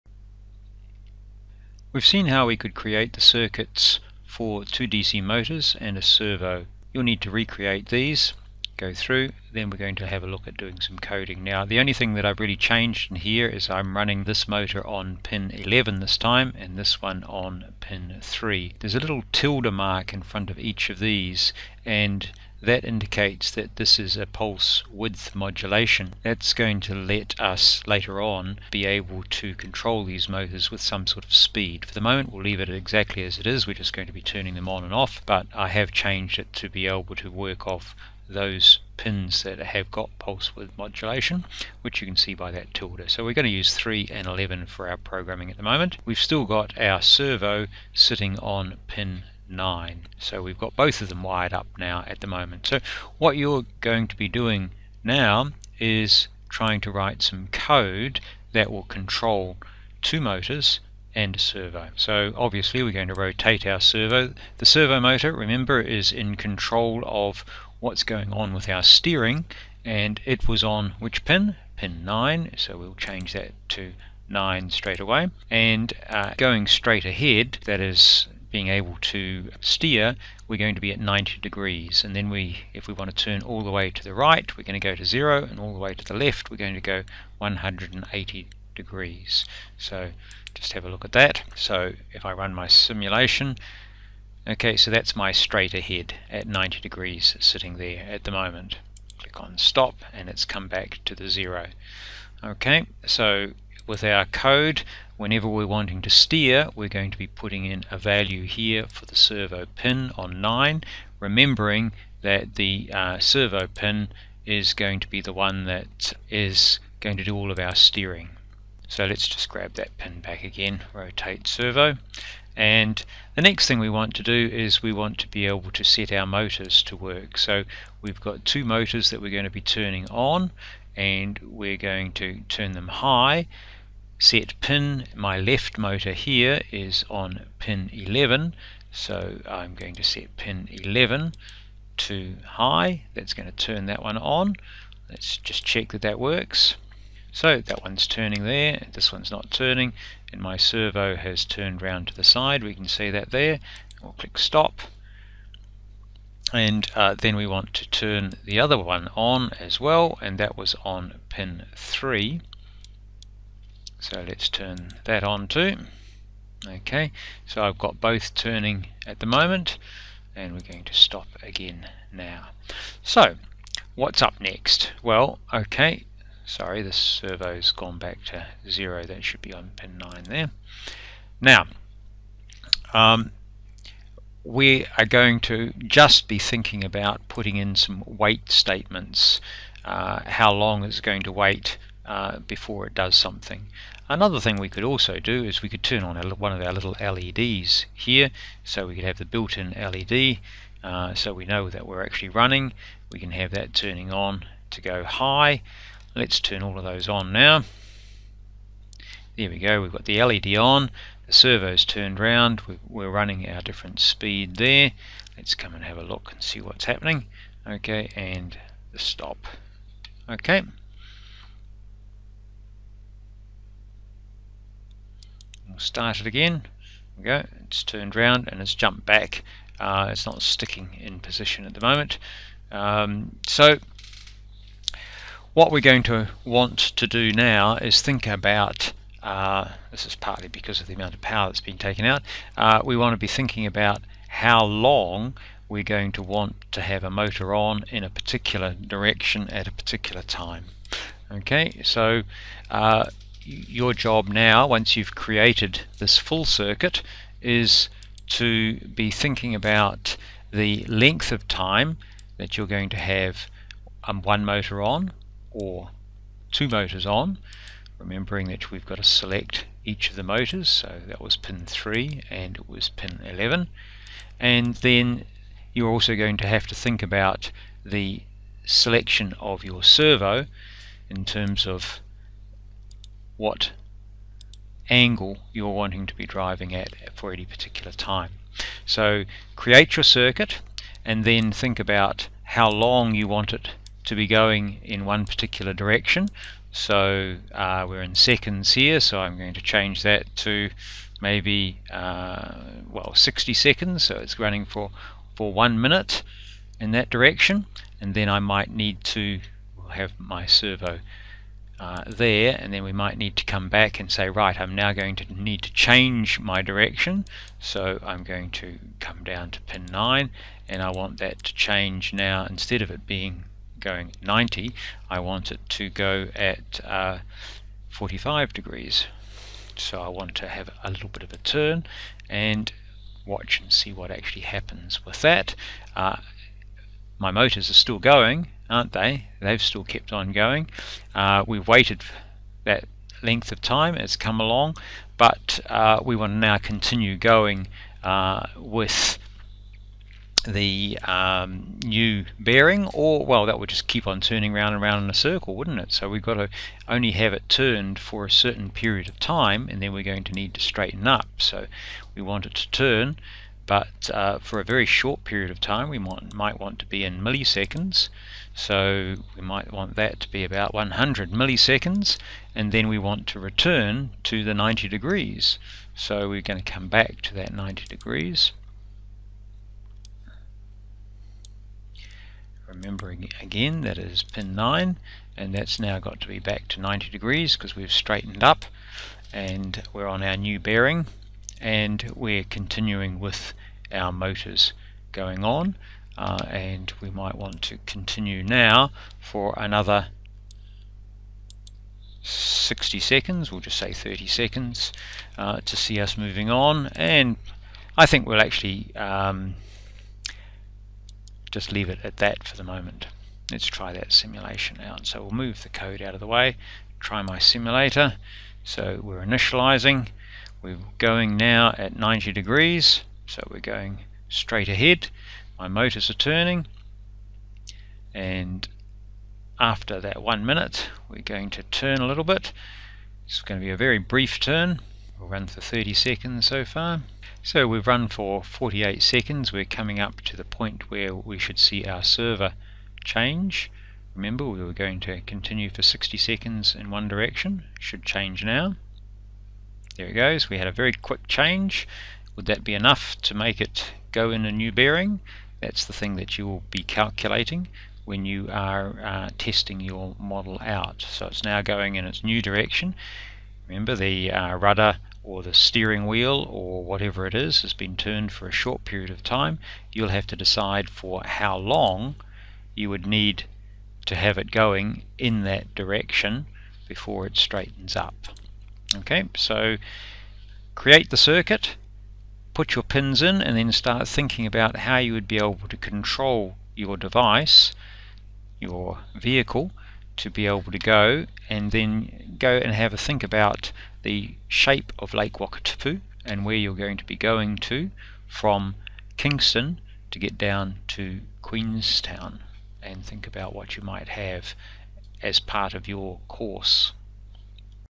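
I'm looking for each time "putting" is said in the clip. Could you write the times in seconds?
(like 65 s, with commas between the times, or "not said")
107 s, 187 s.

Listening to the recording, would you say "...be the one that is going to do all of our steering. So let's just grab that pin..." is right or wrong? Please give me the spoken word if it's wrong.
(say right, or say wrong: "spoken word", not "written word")
right.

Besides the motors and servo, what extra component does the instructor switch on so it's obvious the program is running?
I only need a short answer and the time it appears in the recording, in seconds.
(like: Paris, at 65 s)
built-in LED, at 199 s.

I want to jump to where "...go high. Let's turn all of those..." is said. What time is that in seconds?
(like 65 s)
204 s.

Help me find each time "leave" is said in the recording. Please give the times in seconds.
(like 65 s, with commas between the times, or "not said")
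32 s, 411 s.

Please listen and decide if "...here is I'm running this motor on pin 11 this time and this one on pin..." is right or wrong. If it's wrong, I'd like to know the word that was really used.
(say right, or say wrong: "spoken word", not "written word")
right.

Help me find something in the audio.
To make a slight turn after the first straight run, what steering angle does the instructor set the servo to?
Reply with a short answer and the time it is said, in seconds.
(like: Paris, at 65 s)
45 degrees, at 327 s.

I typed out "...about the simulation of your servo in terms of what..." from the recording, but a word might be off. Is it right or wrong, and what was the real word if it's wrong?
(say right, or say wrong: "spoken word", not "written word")
wrong: "selection", not "simulation".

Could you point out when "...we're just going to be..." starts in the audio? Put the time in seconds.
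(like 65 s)
33 s.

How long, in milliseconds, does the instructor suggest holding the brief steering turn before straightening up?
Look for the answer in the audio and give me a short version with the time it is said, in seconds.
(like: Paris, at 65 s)
100 milliseconds, at 370 s.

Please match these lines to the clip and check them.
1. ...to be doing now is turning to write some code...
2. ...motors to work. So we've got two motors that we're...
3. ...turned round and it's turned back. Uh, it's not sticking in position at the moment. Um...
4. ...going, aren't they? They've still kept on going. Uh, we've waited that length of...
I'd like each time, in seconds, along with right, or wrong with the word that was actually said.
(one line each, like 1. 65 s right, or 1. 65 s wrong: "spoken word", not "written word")
1. 54 s wrong: "trying", not "turning"
2. 126 s right
3. 227 s wrong: "jumped", not "turned"
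4. 337 s right.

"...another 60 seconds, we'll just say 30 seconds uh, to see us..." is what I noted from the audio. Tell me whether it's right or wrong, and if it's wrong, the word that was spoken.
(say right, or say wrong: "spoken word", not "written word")
right.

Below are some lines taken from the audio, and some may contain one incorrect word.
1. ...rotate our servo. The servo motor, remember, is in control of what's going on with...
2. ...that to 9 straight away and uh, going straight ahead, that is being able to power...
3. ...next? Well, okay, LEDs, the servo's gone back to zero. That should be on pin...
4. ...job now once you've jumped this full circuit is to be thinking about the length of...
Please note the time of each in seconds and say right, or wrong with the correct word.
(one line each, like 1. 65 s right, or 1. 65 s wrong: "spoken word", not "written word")
1. 63 s right
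2. 73 s wrong: "steer", not "power"
3. 174 s wrong: "Sorry", not "LEDs"
4. 253 s wrong: "created", not "jumped".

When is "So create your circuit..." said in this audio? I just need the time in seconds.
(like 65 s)
288 s.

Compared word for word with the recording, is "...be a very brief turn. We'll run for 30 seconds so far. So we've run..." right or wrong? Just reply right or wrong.
right.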